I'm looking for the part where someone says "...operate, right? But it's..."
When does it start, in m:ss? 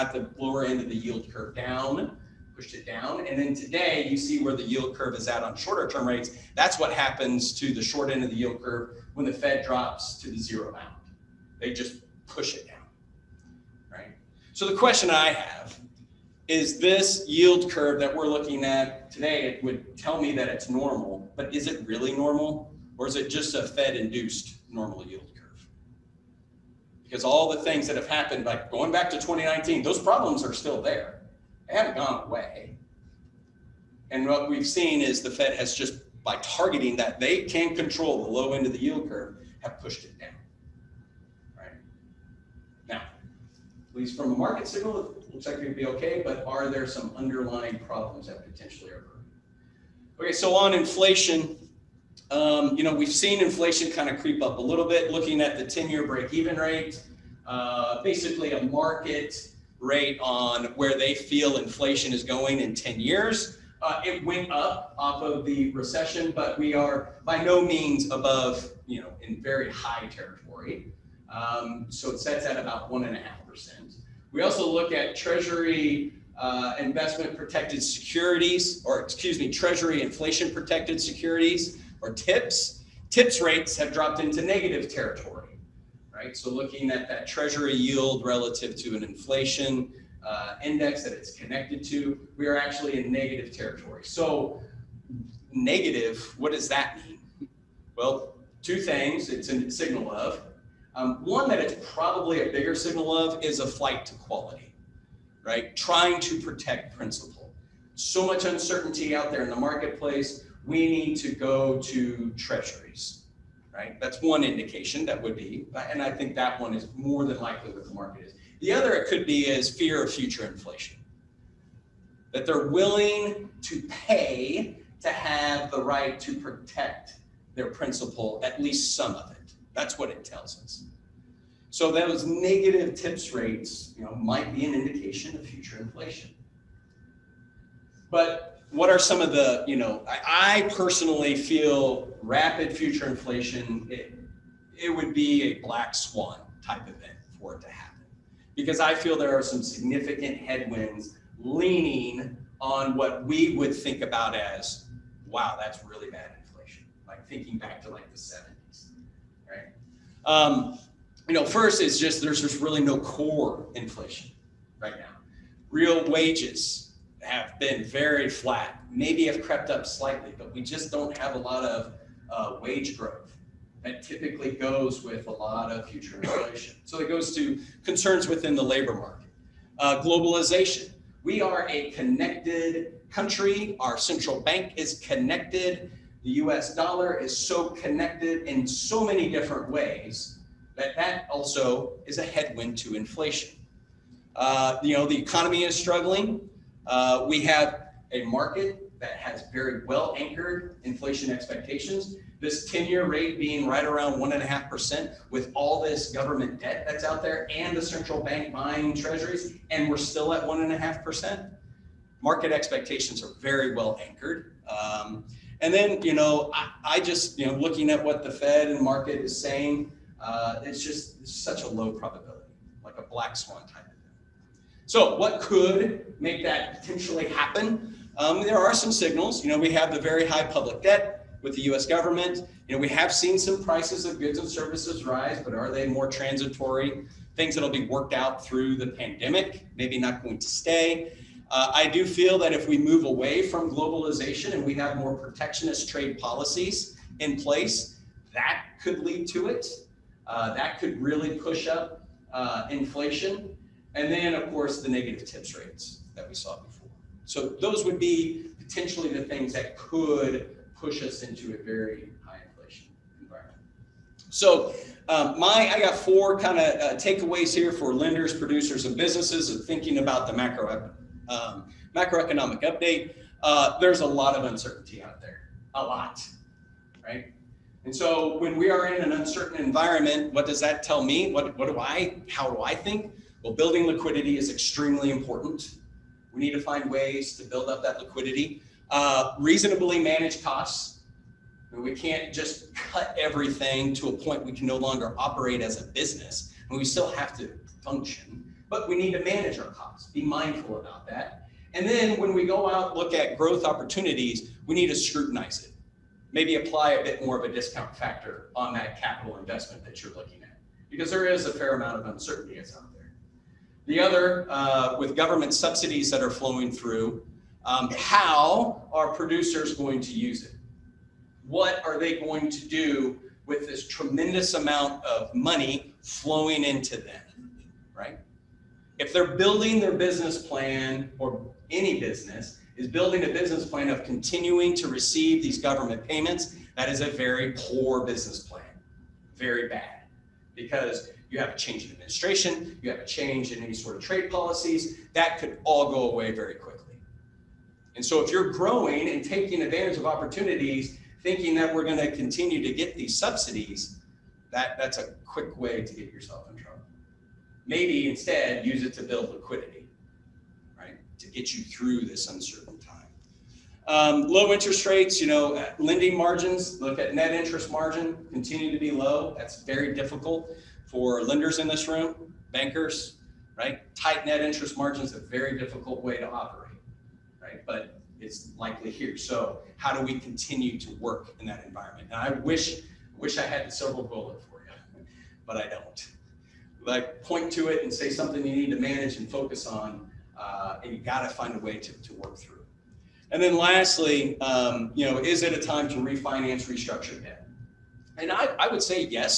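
6:16.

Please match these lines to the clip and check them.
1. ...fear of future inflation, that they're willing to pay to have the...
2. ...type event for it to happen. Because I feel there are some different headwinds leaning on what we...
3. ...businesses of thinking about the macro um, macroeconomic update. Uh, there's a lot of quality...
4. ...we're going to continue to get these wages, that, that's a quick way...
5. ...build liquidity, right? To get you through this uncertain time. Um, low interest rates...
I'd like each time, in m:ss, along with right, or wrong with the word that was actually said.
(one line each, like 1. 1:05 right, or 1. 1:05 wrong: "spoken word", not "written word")
1. 1:59 right
2. 2:26 wrong: "significant", not "different"
3. 4:28 wrong: "uncertainty", not "quality"
4. 5:51 wrong: "subsidies", not "wages"
5. 5:59 right.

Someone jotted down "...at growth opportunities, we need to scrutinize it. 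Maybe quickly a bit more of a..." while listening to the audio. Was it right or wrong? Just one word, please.
wrong.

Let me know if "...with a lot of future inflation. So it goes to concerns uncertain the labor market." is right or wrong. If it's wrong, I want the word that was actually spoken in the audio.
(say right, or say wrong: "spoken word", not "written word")
wrong: "within", not "uncertain".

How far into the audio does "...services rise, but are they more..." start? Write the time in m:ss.
3:54.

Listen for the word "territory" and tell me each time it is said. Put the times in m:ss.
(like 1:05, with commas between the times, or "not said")
1:10, 1:24, 1:33.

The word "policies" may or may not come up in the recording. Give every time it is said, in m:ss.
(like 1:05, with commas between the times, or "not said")
4:06, 5:44.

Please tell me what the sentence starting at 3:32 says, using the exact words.
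Market expectations are very well anchored.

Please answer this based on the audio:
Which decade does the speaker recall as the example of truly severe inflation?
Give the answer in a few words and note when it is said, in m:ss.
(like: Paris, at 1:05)
The 70s, at 2:38.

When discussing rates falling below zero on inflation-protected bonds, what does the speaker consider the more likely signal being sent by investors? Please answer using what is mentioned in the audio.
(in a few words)
Flight to quality.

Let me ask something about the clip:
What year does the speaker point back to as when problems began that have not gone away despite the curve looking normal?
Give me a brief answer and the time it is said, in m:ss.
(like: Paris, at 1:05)
2019, at 0:29.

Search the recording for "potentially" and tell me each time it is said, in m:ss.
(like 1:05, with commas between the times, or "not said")
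0:48, 3:46, 4:18.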